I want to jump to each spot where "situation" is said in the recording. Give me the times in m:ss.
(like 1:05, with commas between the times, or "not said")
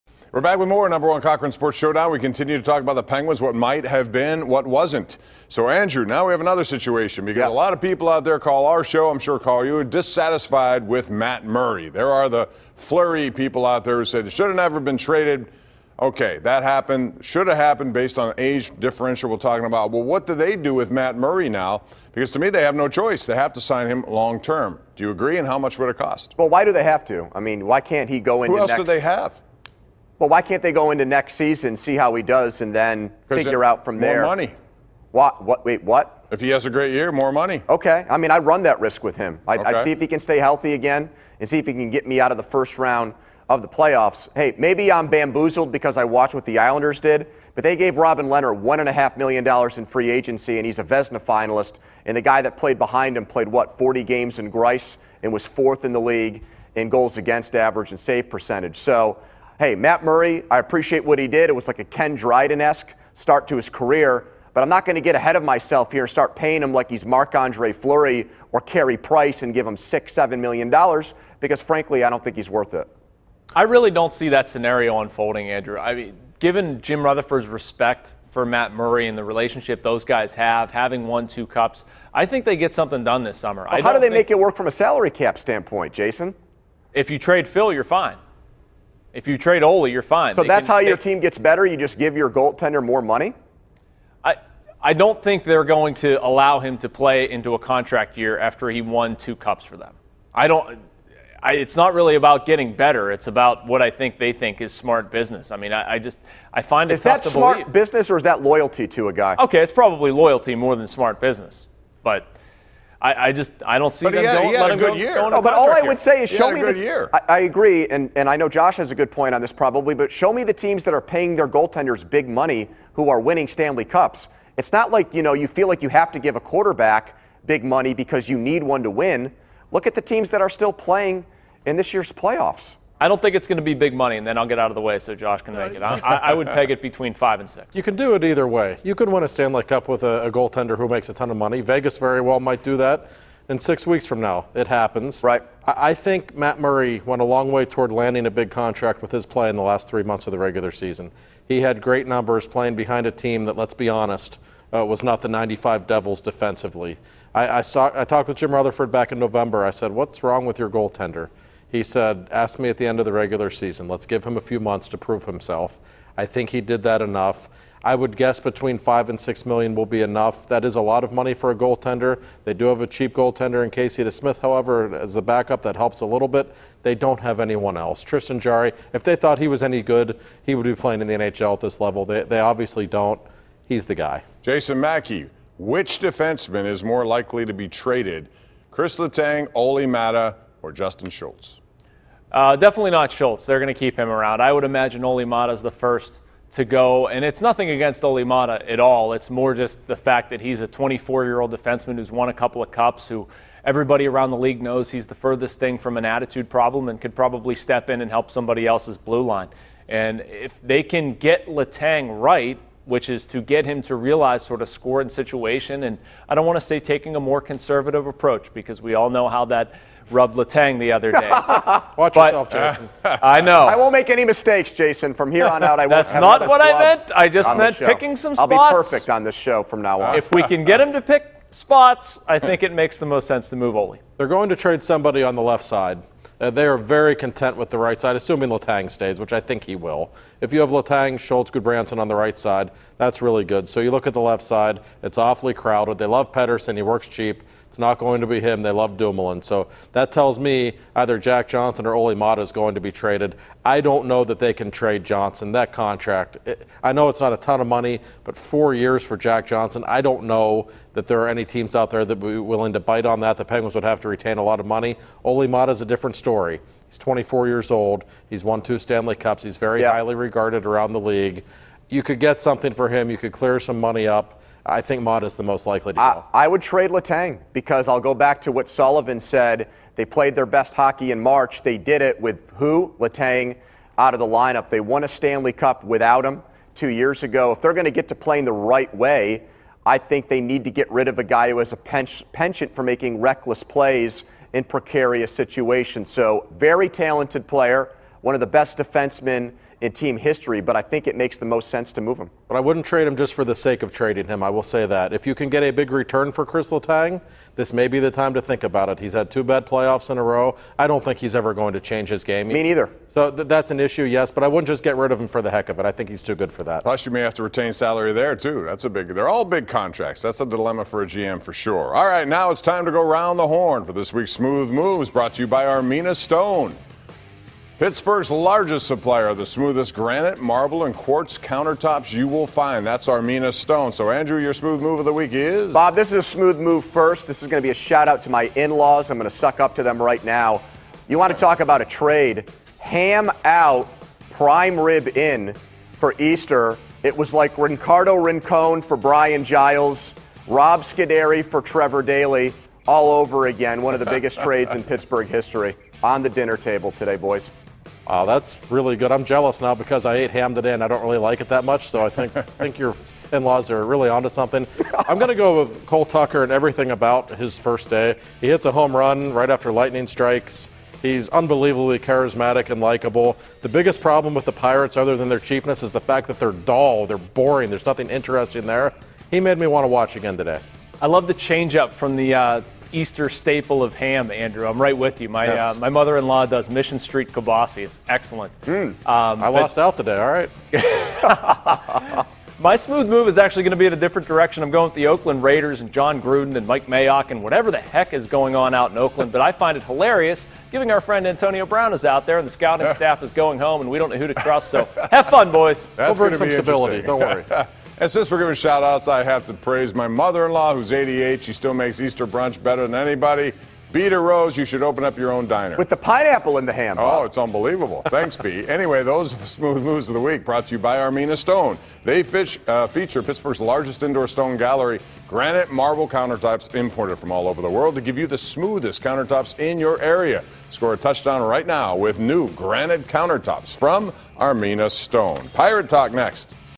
0:06, 3:35, 4:55.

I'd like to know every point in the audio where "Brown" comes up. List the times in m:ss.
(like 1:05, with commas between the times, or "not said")
6:41.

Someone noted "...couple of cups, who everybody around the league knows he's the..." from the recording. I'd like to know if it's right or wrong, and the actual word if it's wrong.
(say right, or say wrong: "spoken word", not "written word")
right.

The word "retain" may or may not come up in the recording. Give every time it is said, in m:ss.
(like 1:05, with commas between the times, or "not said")
4:24, 5:17.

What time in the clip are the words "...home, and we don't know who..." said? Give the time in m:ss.
6:43.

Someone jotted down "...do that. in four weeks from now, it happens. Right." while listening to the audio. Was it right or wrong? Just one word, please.
wrong.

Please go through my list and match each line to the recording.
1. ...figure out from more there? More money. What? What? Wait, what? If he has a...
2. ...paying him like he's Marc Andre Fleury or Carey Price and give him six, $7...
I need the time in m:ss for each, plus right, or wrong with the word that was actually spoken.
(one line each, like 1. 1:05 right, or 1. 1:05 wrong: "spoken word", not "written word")
1. 0:33 right
2. 1:06 right.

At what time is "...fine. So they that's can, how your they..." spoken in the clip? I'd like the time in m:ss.
1:30.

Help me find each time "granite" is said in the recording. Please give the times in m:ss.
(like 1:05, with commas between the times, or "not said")
5:29, 7:05, 7:12.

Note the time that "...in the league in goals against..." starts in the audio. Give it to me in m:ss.
0:55.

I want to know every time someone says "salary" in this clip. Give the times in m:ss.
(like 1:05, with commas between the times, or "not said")
1:24, 5:17.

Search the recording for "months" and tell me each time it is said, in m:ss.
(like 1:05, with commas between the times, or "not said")
2:30, 2:44.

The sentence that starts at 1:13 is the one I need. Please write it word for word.
I really don't see that scenario unfolding, Andrew.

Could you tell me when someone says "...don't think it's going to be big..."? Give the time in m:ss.
2:13.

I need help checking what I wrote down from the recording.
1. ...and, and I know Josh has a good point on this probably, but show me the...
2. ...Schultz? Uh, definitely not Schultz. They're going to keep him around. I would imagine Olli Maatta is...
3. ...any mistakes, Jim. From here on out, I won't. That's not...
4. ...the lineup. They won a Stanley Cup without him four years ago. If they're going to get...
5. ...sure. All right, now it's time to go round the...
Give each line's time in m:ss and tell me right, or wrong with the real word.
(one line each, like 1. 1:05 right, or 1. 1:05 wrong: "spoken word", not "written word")
1. 1:57 right
2. 3:11 right
3. 3:44 wrong: "Jason", not "Jim"
4. 4:44 wrong: "two", not "four"
5. 5:21 right.